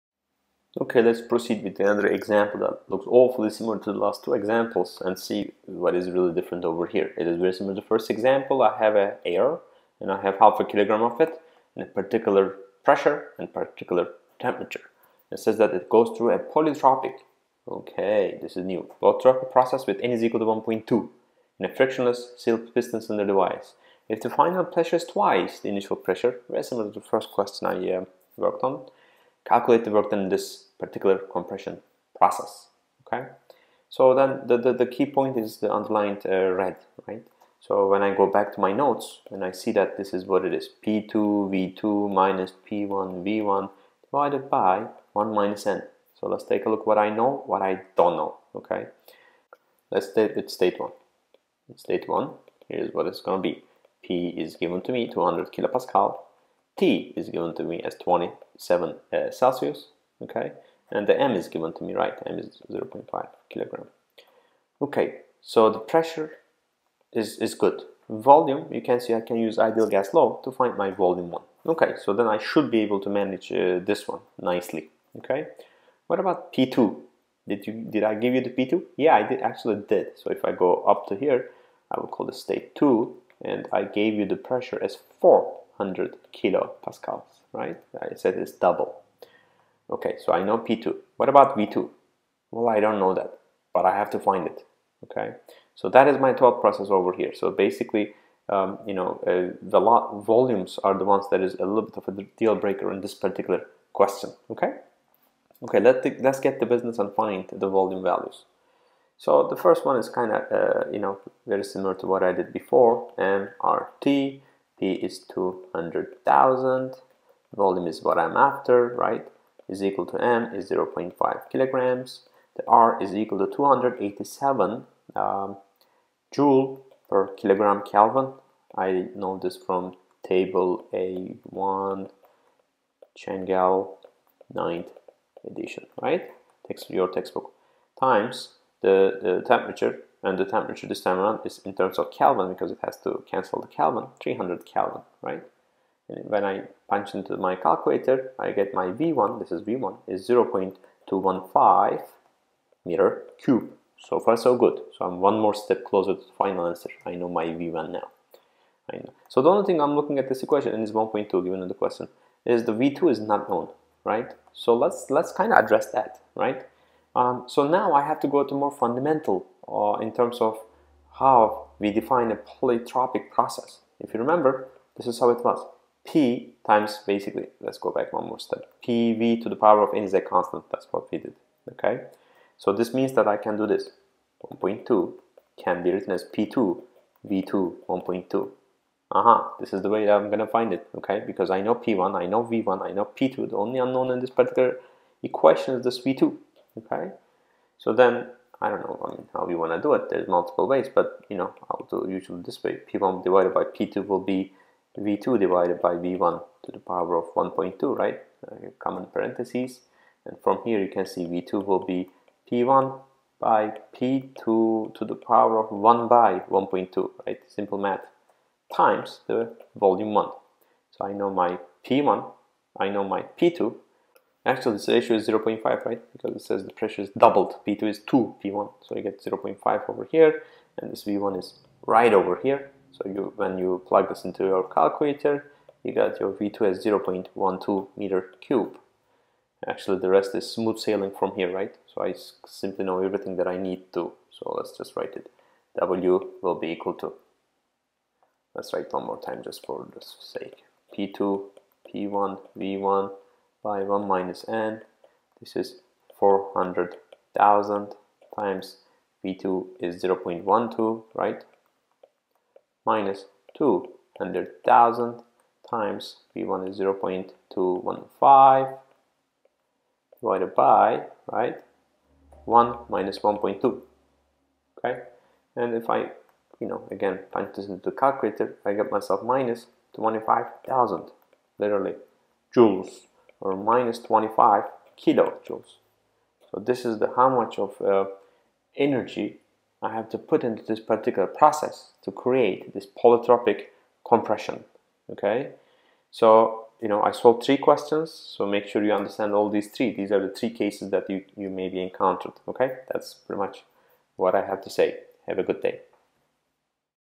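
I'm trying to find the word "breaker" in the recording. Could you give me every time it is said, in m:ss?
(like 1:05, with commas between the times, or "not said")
1:42.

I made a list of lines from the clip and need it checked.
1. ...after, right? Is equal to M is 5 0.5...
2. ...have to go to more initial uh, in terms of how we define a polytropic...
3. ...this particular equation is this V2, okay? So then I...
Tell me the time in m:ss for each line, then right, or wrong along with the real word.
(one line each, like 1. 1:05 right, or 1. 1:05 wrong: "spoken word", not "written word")
1. 1:58 wrong: "0", not "5"
2. 2:48 wrong: "fundamental", not "initial"
3. 3:14 right.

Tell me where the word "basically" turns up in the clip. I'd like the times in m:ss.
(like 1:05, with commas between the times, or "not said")
1:37, 2:57.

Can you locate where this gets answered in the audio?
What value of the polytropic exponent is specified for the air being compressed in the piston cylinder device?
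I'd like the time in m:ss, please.
0:20.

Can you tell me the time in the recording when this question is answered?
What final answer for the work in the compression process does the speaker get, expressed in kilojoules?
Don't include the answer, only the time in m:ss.
4:43.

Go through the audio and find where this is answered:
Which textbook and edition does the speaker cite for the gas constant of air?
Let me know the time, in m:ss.
2:13.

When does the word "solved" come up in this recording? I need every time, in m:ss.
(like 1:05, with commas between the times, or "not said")
4:57.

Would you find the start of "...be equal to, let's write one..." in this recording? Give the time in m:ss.
4:06.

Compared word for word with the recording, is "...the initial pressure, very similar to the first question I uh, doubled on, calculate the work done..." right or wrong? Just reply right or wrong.
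wrong.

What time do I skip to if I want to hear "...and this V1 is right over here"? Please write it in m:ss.
3:50.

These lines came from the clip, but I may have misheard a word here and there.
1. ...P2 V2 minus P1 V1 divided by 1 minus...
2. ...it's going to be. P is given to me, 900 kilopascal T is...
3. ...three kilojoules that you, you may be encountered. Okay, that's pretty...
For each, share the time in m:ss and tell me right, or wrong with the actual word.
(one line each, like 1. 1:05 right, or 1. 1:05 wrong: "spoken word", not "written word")
1. 0:40 right
2. 0:53 wrong: "200", not "900"
3. 5:00 wrong: "cases", not "kilojoules".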